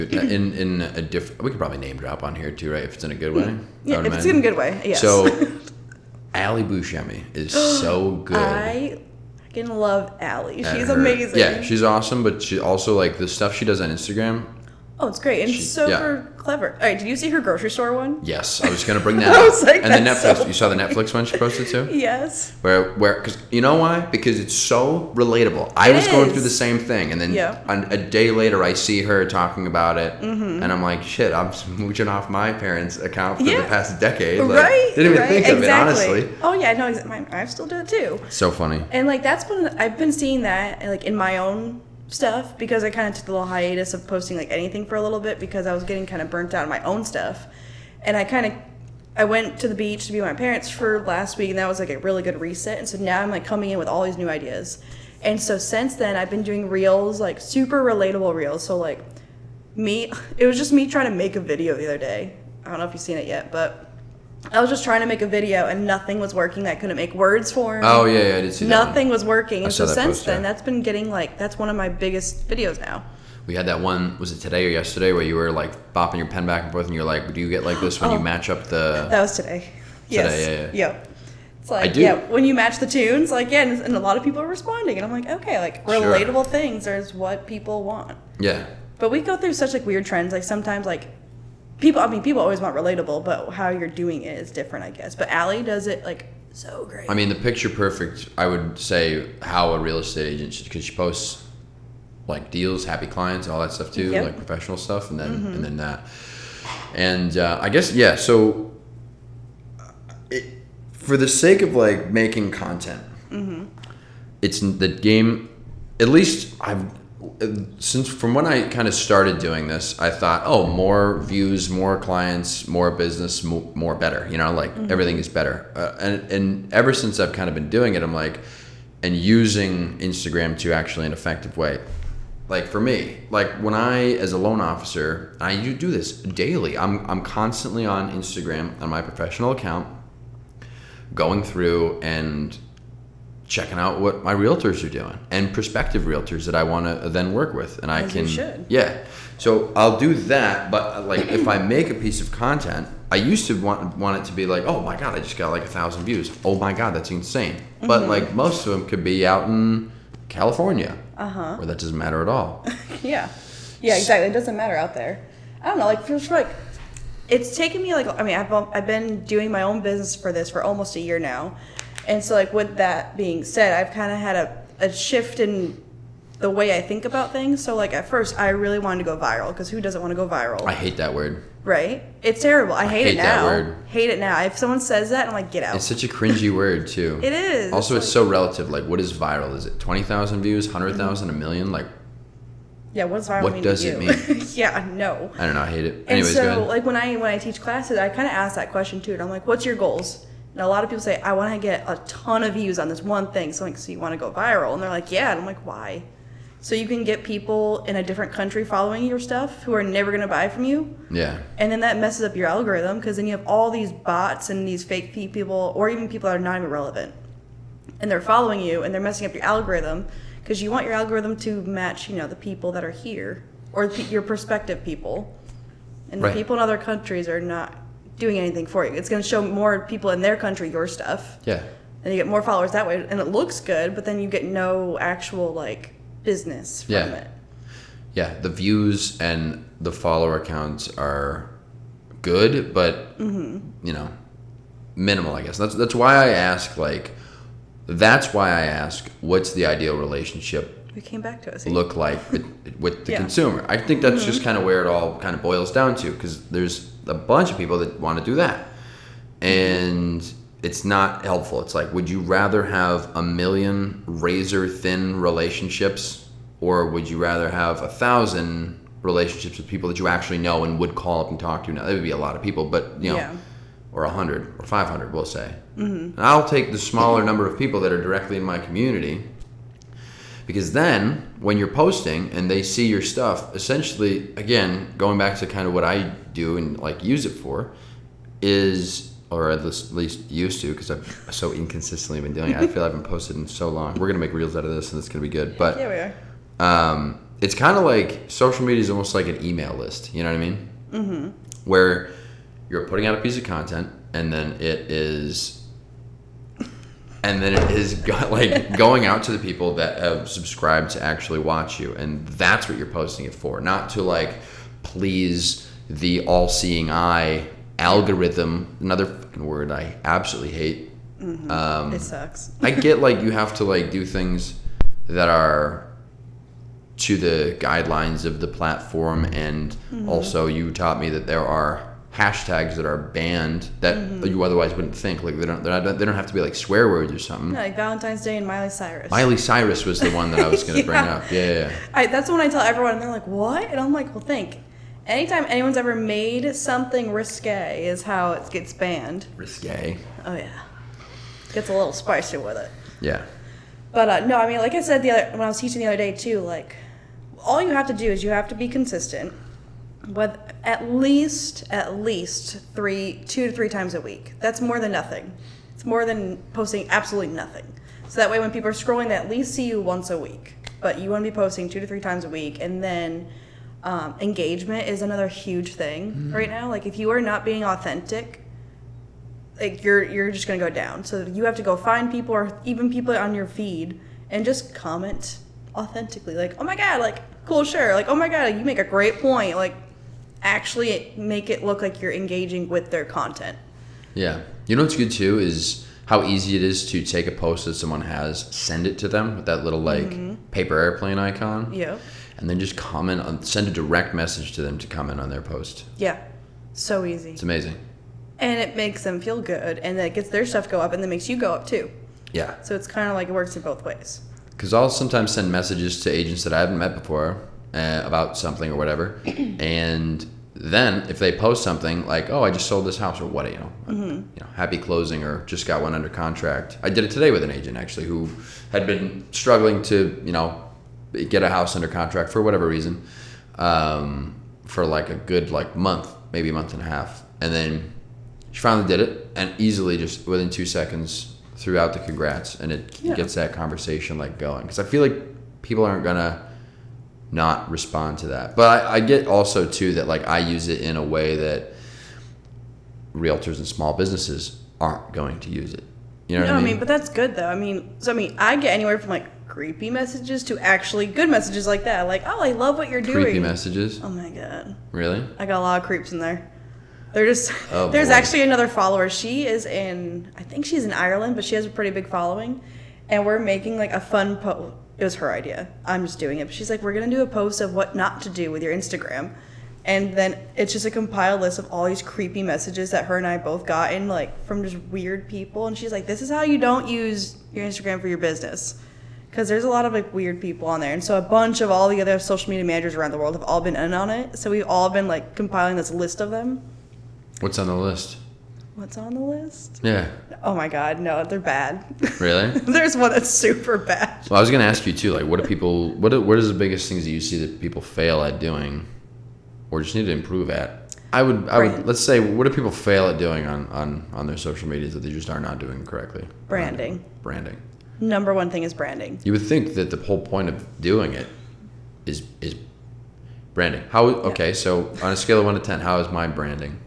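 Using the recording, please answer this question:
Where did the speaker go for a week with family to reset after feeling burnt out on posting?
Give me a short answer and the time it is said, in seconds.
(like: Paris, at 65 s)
the beach, at 49 s.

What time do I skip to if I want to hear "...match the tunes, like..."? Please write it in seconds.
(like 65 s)
82 s.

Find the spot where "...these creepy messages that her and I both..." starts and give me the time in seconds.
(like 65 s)
481 s.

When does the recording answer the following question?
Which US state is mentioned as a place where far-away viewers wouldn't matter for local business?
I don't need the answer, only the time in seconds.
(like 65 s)
160 s.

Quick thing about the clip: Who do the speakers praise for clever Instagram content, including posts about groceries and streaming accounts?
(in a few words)
Ali Buscemi.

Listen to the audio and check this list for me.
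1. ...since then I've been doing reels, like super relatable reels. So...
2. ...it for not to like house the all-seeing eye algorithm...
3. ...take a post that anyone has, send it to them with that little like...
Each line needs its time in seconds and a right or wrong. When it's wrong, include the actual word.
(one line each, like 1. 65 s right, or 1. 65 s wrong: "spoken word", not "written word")
1. 55 s right
2. 313 s wrong: "please", not "house"
3. 397 s wrong: "someone", not "anyone".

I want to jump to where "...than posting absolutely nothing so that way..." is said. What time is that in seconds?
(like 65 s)
366 s.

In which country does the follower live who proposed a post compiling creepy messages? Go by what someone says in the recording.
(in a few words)
Ireland.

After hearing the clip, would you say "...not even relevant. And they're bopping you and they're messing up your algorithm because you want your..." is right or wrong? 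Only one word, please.
wrong.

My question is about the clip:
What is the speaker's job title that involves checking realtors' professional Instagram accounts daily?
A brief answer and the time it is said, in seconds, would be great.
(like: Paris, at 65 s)
loan officer, at 134 s.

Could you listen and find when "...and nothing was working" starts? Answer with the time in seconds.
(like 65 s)
65 s.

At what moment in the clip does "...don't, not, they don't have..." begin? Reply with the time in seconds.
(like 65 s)
335 s.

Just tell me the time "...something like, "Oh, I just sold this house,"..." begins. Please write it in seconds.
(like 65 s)
421 s.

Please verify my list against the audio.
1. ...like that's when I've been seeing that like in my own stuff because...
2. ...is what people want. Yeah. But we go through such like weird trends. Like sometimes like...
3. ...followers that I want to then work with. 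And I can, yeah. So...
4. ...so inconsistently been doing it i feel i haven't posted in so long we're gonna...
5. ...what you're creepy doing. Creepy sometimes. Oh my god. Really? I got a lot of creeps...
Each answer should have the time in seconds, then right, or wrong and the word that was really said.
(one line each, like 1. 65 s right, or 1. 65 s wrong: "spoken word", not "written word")
1. 39 s right
2. 86 s right
3. 146 s wrong: "realtors", not "followers"
4. 291 s right
5. 462 s wrong: "messages", not "sometimes".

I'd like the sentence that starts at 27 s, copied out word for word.
on, a day later, I see her talking about it, mm-hmm.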